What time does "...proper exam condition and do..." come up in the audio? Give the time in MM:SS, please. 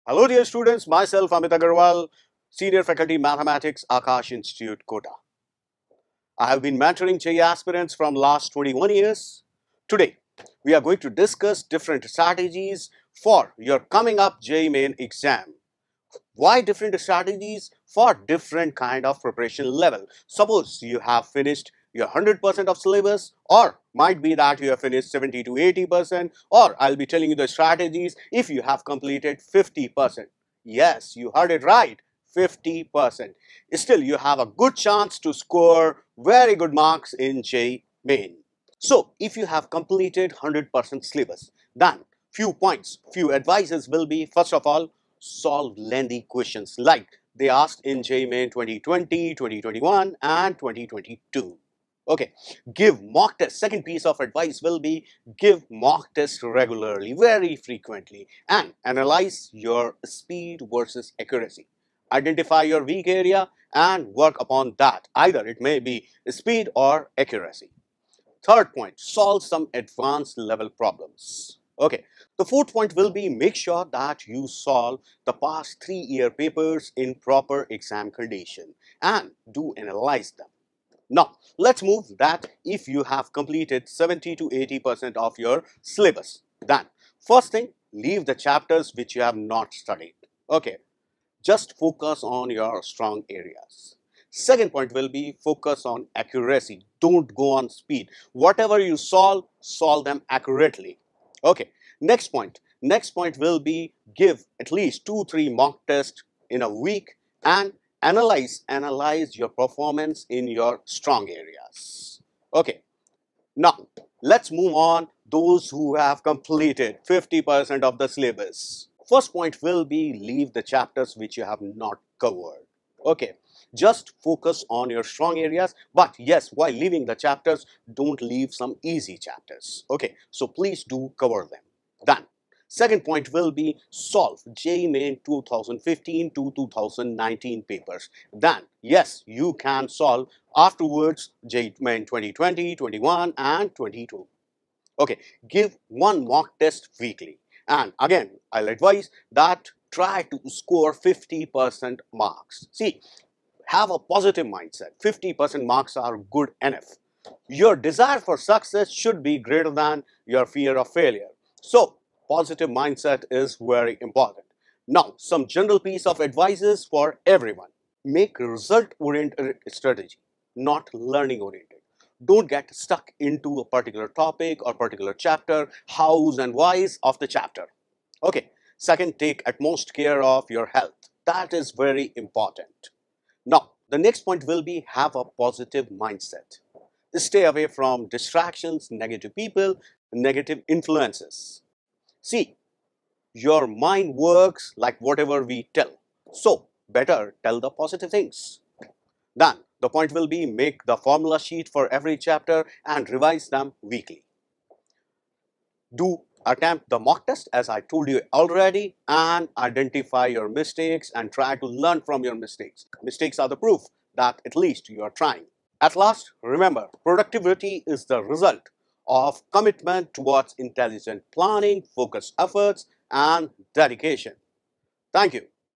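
01:17.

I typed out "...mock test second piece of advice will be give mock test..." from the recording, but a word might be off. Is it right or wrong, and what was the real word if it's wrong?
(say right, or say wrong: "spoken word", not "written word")
right.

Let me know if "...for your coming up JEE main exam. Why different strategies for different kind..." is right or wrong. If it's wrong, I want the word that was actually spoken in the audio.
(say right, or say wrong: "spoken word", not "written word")
right.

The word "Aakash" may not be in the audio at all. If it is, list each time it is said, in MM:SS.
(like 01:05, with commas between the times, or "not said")
00:03.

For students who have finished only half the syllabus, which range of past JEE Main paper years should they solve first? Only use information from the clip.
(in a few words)
2015 to 2019.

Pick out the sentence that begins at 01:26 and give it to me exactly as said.
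Then, first thing, leave the chapters which you have not studied.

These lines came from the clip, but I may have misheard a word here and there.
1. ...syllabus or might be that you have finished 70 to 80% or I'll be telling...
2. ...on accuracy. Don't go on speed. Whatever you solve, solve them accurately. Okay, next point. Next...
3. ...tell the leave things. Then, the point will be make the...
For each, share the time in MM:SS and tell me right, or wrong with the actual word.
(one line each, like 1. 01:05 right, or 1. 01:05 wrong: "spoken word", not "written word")
1. 00:22 right
2. 01:35 right
3. 03:17 wrong: "positive", not "leave".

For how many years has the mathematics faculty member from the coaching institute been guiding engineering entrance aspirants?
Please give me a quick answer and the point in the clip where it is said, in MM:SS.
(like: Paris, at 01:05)
21, at 00:08.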